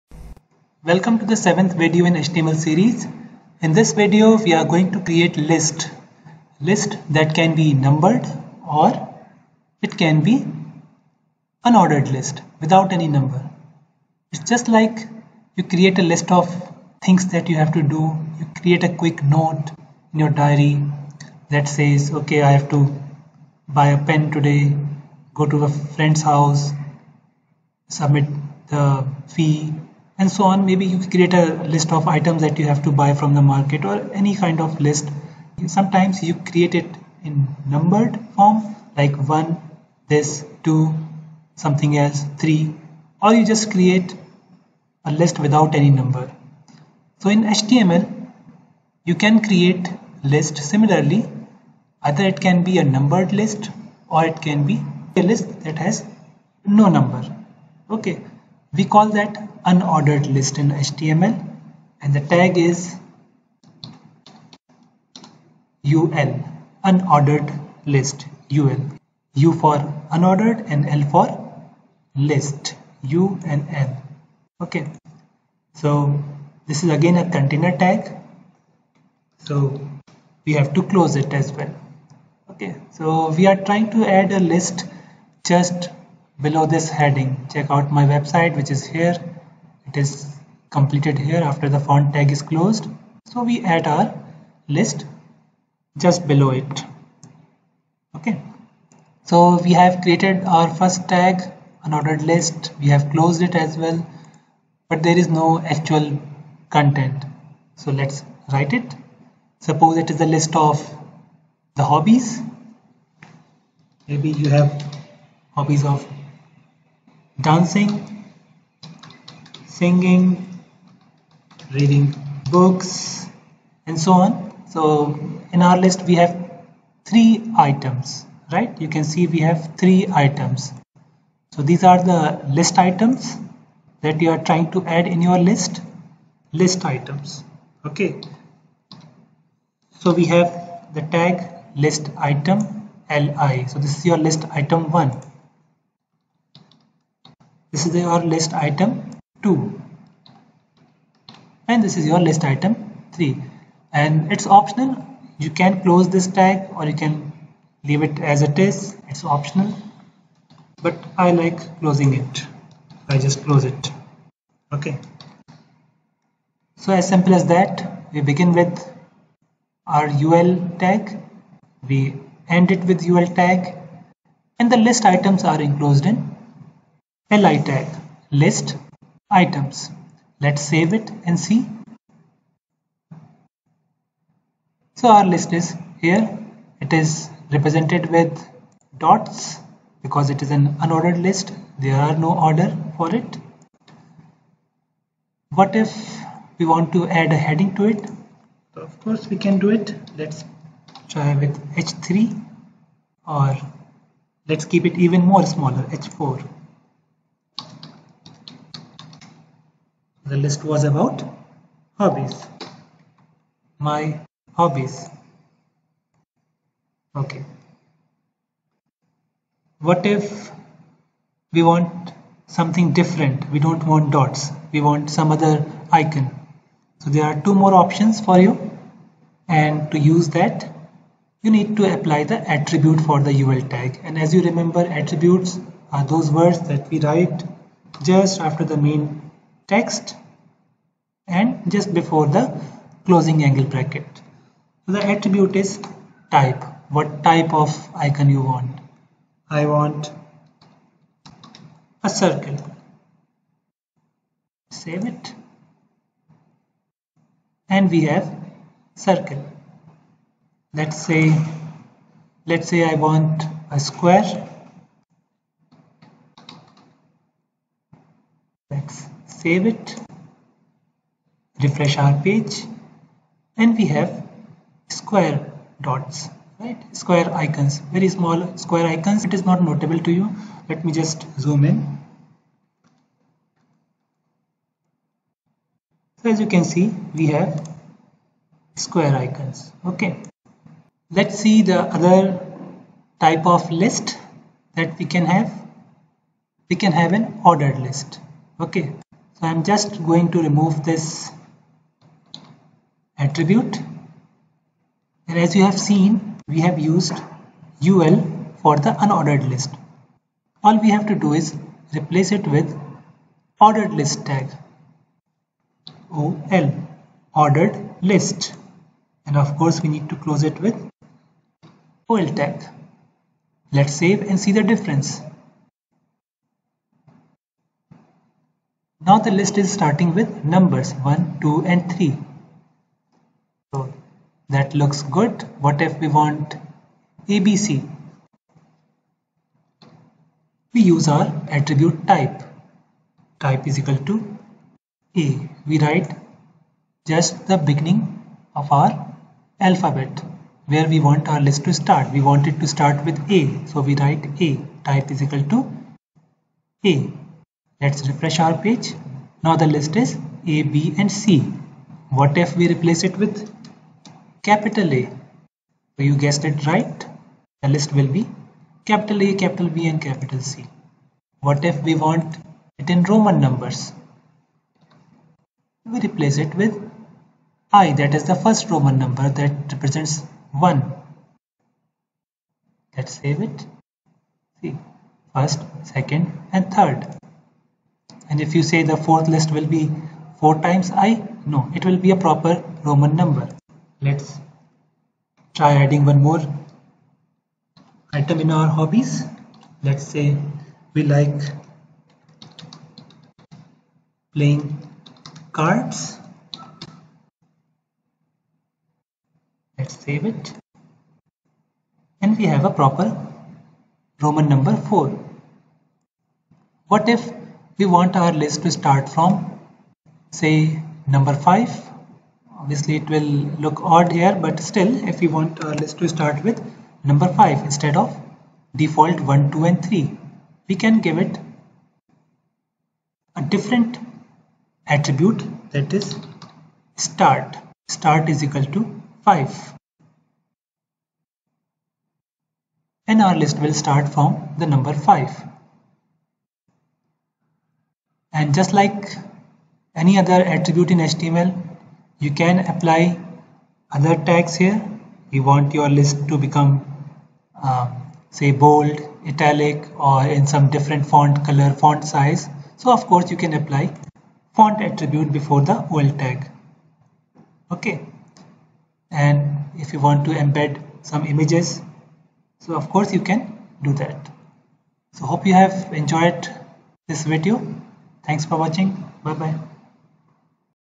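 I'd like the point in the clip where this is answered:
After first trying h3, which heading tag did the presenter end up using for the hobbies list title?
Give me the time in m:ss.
3:26.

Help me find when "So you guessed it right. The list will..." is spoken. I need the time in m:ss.
6:05.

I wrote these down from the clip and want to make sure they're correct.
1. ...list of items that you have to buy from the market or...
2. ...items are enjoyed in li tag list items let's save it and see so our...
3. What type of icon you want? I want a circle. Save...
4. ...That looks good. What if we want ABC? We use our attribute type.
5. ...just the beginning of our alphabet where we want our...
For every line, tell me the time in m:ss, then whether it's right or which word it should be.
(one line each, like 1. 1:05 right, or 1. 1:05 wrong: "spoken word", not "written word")
1. 0:31 right
2. 2:55 wrong: "enclosed", not "enjoyed"
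3. 4:06 right
4. 5:34 right
5. 5:47 right.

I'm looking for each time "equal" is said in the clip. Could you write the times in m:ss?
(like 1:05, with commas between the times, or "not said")
5:43, 5:55, 7:18.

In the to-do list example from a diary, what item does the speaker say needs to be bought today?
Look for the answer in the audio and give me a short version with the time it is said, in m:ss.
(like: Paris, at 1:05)
A pen, at 0:23.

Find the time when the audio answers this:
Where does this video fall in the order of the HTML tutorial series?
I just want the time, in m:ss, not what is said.
0:01.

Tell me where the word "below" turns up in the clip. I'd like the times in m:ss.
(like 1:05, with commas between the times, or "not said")
1:26, 1:36.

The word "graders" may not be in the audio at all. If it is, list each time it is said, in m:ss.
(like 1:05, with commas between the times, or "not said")
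not said.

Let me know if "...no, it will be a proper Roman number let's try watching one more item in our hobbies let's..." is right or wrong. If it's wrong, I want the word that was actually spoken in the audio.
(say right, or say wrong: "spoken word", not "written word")
wrong: "adding", not "watching".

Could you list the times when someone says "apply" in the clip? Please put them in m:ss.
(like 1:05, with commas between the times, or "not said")
3:51, 7:32, 7:43.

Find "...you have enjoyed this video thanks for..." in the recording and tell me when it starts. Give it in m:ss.
7:55.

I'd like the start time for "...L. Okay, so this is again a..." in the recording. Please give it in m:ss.
1:13.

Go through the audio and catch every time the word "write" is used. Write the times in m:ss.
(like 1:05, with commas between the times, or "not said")
1:48, 3:57, 5:45, 5:53.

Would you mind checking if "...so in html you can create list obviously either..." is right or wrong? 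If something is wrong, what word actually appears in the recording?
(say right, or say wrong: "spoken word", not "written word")
wrong: "similarly", not "obviously".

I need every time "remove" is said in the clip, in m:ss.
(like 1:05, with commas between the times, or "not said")
5:00.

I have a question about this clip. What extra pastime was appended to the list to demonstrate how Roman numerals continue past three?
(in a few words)
Playing cards.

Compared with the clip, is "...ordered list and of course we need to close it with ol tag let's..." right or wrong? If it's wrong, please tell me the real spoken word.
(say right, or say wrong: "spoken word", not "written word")
right.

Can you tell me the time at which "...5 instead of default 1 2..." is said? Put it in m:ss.
7:07.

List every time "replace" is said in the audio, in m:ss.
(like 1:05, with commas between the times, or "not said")
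5:11, 6:02, 6:15.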